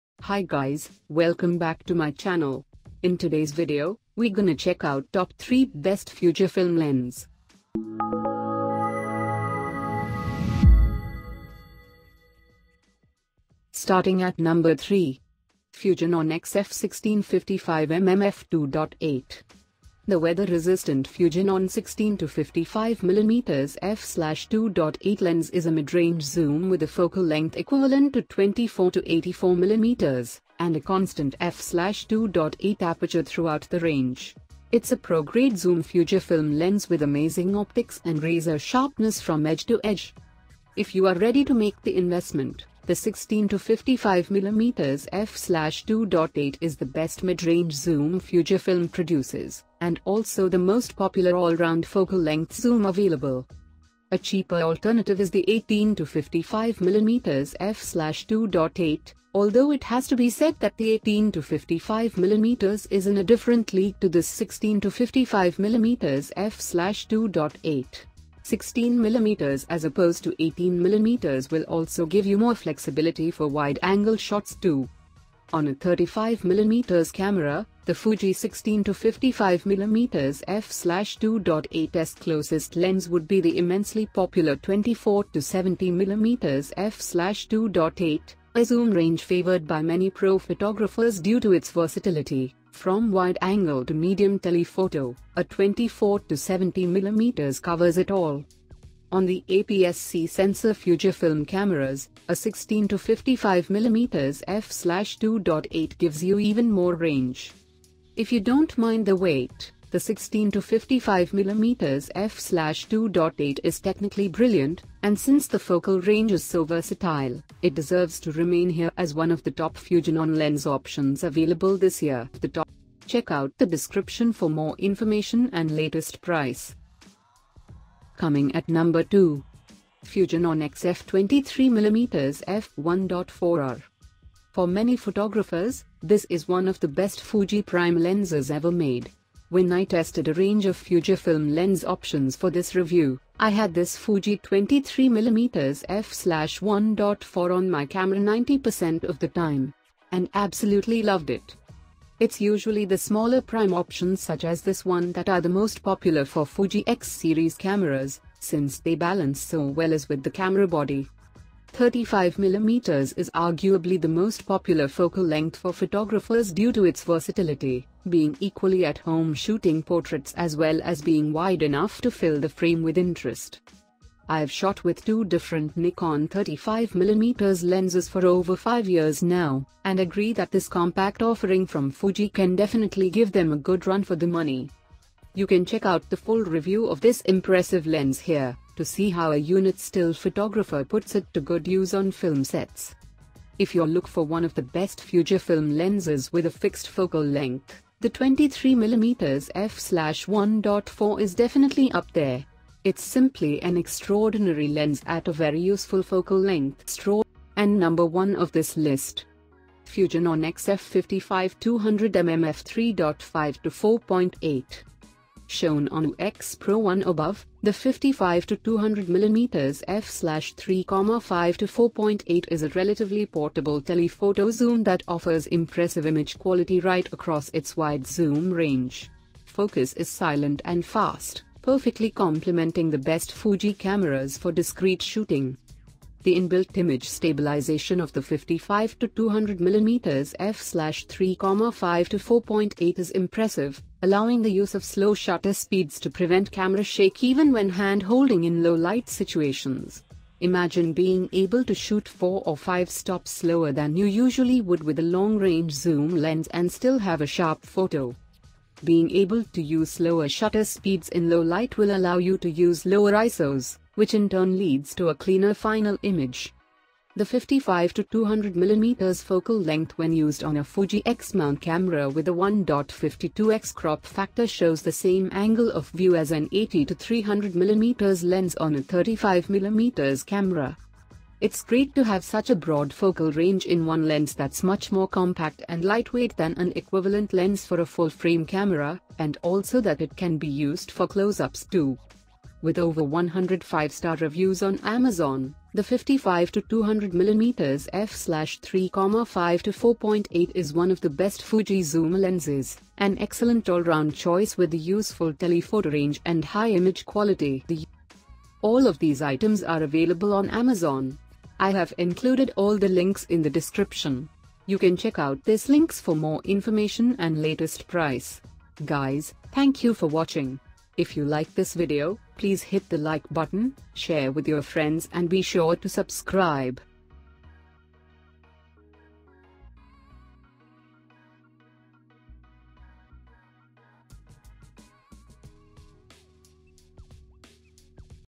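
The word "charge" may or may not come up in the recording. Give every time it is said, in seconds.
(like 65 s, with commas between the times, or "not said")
not said.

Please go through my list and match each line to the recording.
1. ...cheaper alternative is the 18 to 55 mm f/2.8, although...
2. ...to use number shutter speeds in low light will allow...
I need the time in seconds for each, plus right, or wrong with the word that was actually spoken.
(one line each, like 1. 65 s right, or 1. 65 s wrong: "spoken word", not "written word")
1. 54 s right
2. 259 s wrong: "slower", not "number".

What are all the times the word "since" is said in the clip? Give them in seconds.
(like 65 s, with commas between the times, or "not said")
115 s, 158 s.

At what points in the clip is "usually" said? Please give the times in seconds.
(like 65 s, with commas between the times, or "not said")
152 s, 254 s.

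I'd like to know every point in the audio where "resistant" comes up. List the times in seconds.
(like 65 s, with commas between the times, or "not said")
20 s.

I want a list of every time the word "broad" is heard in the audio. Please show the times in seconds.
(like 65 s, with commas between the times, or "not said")
282 s.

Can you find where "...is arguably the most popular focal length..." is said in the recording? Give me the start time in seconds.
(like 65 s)
163 s.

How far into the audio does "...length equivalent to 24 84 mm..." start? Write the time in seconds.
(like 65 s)
27 s.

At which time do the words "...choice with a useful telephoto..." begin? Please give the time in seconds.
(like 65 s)
304 s.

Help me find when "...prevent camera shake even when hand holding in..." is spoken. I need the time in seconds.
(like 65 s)
246 s.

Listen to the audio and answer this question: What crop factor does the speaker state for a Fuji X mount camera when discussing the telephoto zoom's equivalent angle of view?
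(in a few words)
1.52x.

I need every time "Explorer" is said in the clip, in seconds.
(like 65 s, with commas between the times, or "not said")
not said.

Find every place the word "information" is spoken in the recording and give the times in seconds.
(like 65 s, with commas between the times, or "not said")
124 s, 316 s.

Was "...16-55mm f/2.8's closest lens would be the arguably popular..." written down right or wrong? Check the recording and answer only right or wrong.
wrong.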